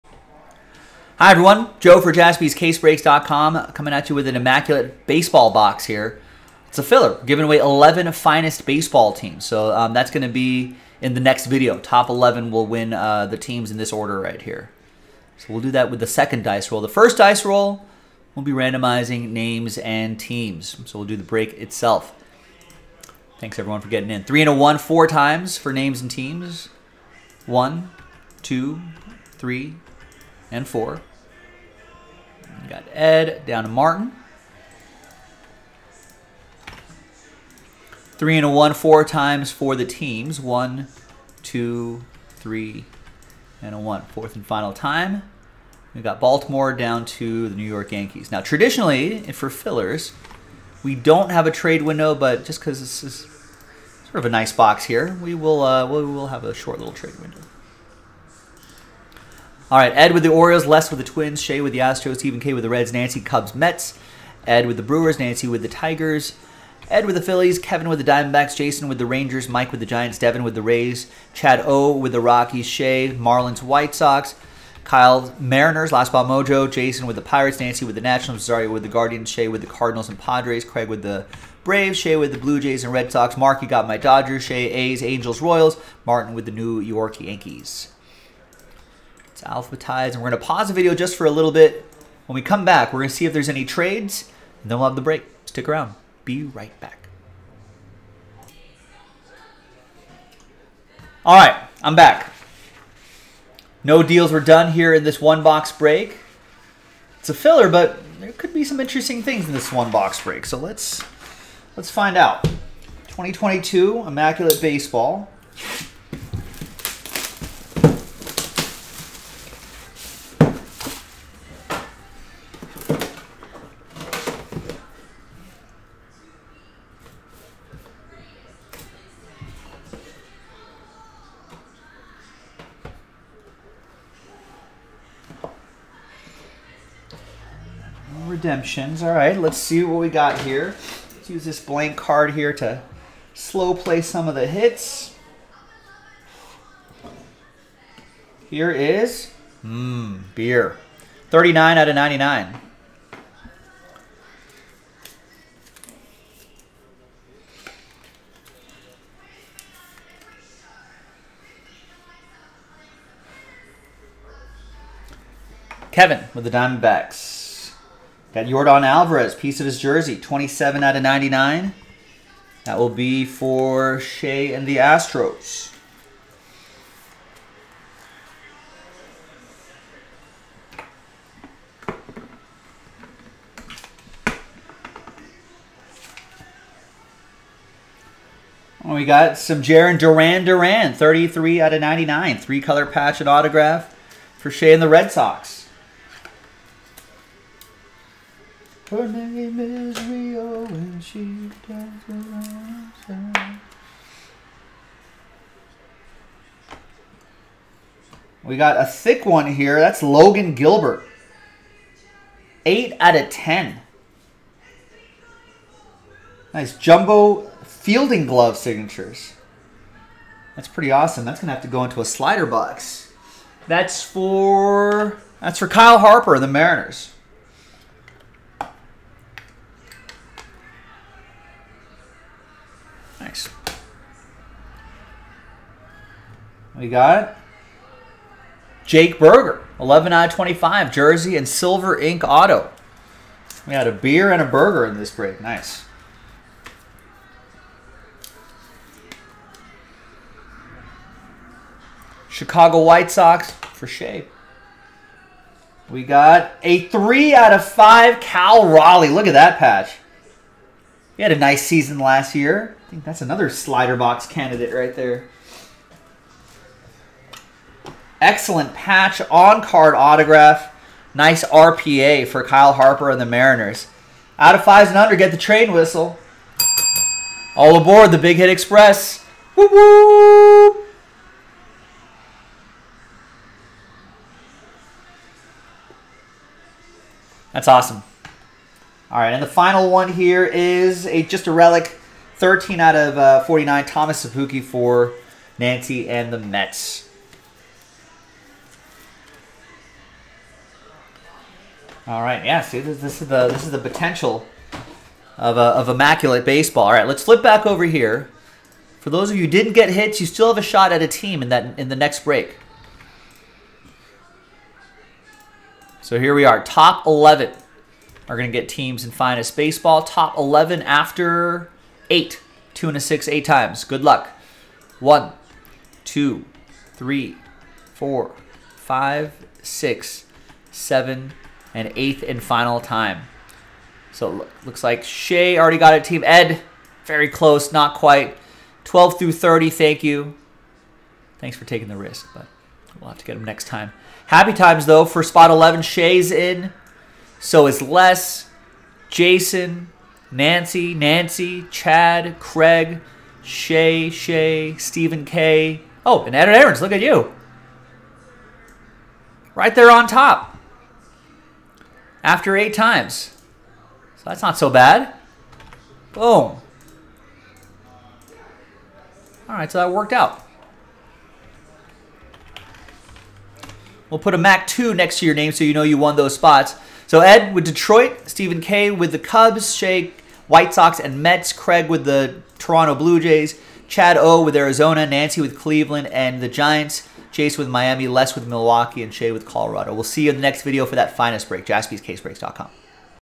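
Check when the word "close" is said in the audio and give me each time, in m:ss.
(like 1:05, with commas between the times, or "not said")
5:37.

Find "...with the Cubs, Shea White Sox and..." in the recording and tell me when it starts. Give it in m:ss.
6:18.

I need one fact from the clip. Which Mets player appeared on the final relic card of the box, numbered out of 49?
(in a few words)
Thomas Szapucki.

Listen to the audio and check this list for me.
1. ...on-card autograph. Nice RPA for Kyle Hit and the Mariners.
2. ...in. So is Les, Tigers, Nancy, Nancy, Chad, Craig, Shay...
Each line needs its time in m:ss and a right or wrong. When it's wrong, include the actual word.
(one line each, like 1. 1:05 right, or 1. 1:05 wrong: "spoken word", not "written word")
1. 4:29 wrong: "Harper", not "Hit"
2. 5:46 wrong: "Jason", not "Tigers".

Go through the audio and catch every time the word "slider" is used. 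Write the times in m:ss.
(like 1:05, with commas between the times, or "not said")
3:42, 4:23.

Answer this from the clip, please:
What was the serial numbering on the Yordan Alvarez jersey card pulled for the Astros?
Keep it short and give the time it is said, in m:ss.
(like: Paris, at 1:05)
27 out of 99, at 2:50.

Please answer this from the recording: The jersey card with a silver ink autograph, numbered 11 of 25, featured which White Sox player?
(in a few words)
Jake Burger.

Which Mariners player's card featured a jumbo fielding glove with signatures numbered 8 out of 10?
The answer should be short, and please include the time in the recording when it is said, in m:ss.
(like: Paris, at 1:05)
Logan Gilbert, at 3:30.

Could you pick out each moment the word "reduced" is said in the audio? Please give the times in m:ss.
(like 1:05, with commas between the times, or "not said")
not said.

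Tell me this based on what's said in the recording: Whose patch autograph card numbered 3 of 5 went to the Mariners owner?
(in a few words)
Cal Raleigh.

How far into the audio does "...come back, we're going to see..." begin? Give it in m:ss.
1:32.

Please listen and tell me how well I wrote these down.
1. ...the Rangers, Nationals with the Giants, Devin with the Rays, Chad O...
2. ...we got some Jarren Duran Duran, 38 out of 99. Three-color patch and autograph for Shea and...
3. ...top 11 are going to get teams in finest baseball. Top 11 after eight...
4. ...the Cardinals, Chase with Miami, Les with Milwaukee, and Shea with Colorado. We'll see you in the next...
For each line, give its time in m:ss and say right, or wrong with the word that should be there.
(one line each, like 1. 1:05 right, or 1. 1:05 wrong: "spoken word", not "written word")
1. 1:08 wrong: "Mike", not "Nationals"
2. 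3:08 wrong: "33", not "38"
3. 5:16 right
4. 6:26 wrong: "Giants", not "Cardinals".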